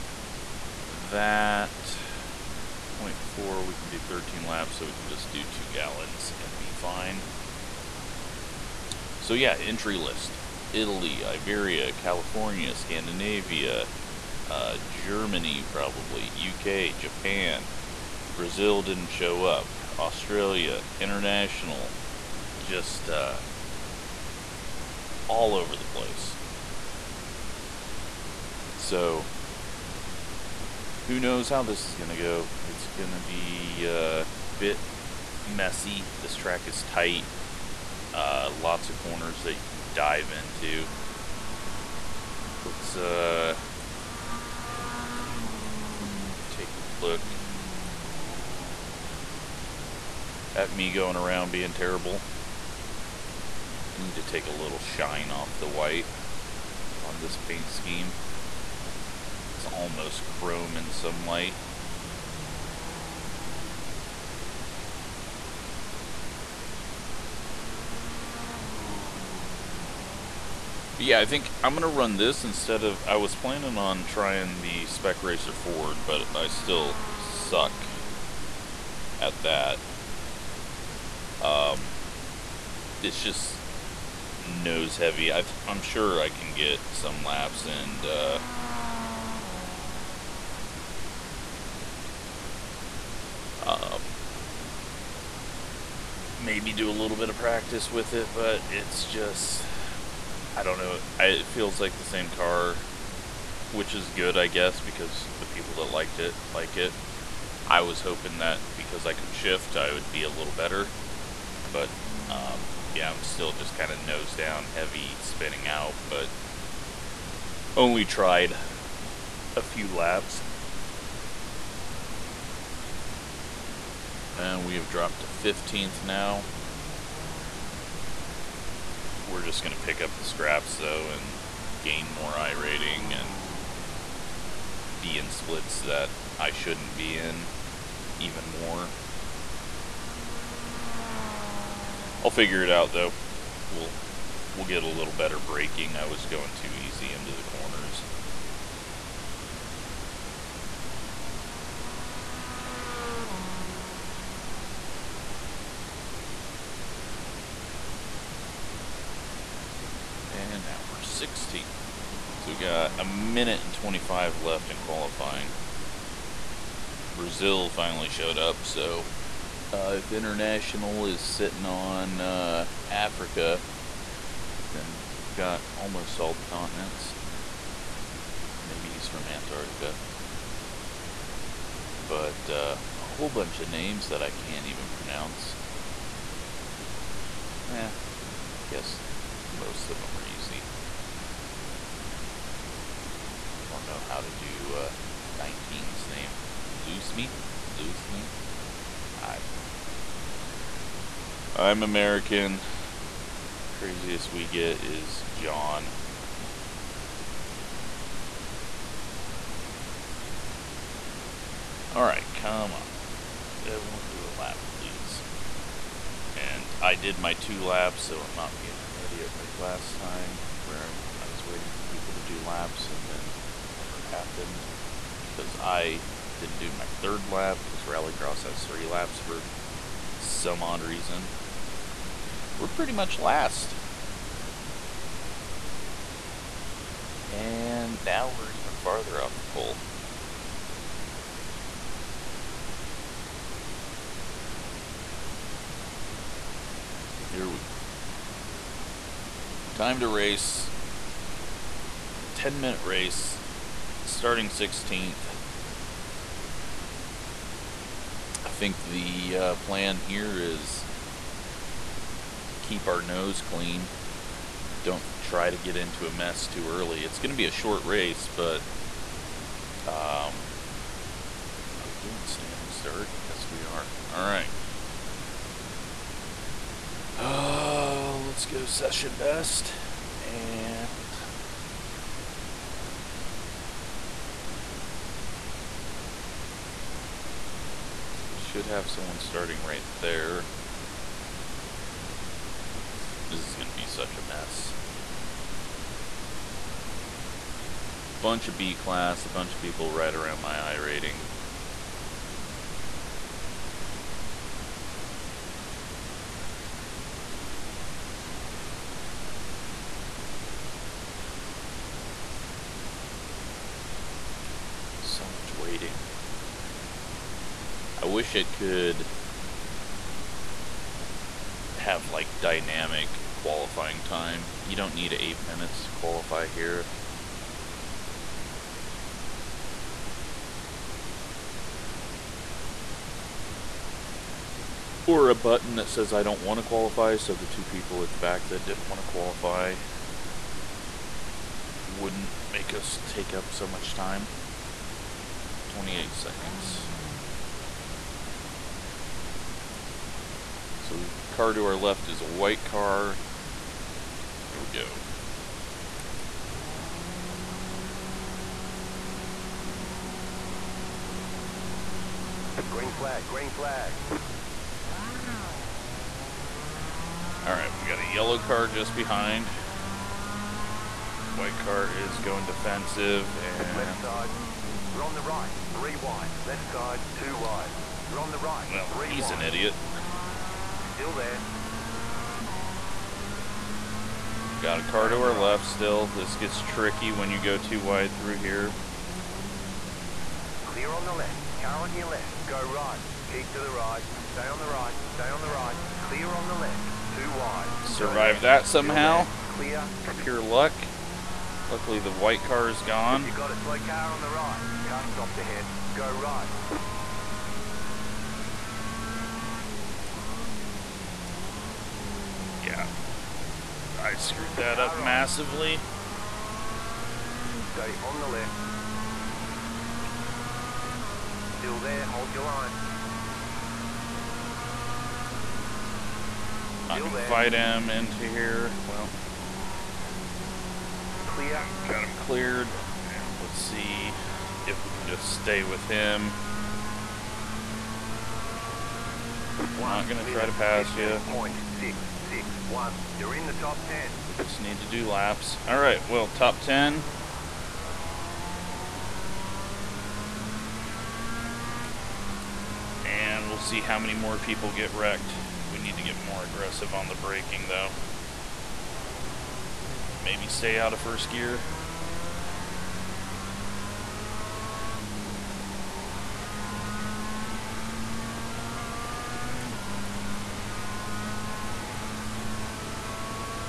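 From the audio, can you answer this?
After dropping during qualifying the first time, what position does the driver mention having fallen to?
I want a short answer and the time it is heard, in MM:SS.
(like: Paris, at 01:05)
15th, at 02:05.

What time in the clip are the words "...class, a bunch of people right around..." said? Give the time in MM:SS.
04:58.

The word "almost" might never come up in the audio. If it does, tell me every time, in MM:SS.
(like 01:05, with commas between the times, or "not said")
00:59, 02:55.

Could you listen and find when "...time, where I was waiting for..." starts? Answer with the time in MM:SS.
03:39.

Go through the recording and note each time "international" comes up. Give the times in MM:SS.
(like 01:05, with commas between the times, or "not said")
00:21, 02:50.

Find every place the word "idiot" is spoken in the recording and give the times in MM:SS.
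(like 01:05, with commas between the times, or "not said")
03:39, 06:19.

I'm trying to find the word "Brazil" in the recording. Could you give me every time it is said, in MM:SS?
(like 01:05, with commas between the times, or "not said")
00:18, 02:47.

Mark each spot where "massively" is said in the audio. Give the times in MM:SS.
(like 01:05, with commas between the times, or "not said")
06:54.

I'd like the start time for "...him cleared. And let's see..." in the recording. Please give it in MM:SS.
07:12.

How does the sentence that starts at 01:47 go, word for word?
I was hoping that because I could shift, I would be a little better.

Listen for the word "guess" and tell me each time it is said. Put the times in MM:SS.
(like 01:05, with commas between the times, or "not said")
01:44, 03:08.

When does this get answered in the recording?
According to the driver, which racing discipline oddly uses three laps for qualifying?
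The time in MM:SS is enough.
03:47.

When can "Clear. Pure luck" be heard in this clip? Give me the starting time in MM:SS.
06:39.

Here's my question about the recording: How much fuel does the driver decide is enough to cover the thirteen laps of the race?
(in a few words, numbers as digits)
2 gallons.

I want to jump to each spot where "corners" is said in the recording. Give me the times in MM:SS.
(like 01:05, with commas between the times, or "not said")
00:38, 02:27.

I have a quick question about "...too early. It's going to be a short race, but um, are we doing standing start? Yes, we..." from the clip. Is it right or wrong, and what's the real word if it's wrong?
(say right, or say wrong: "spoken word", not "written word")
right.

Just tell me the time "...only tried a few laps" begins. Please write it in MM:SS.
01:57.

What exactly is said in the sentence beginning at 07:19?
We're not gonna try to pass you.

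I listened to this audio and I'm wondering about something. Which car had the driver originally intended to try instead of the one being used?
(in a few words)
Spec Racer Ford.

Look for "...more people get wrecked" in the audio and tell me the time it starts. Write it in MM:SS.
07:34.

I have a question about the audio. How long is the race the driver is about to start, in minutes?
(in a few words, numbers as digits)
10 minutes.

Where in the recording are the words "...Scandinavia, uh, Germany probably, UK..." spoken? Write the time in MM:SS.
00:12.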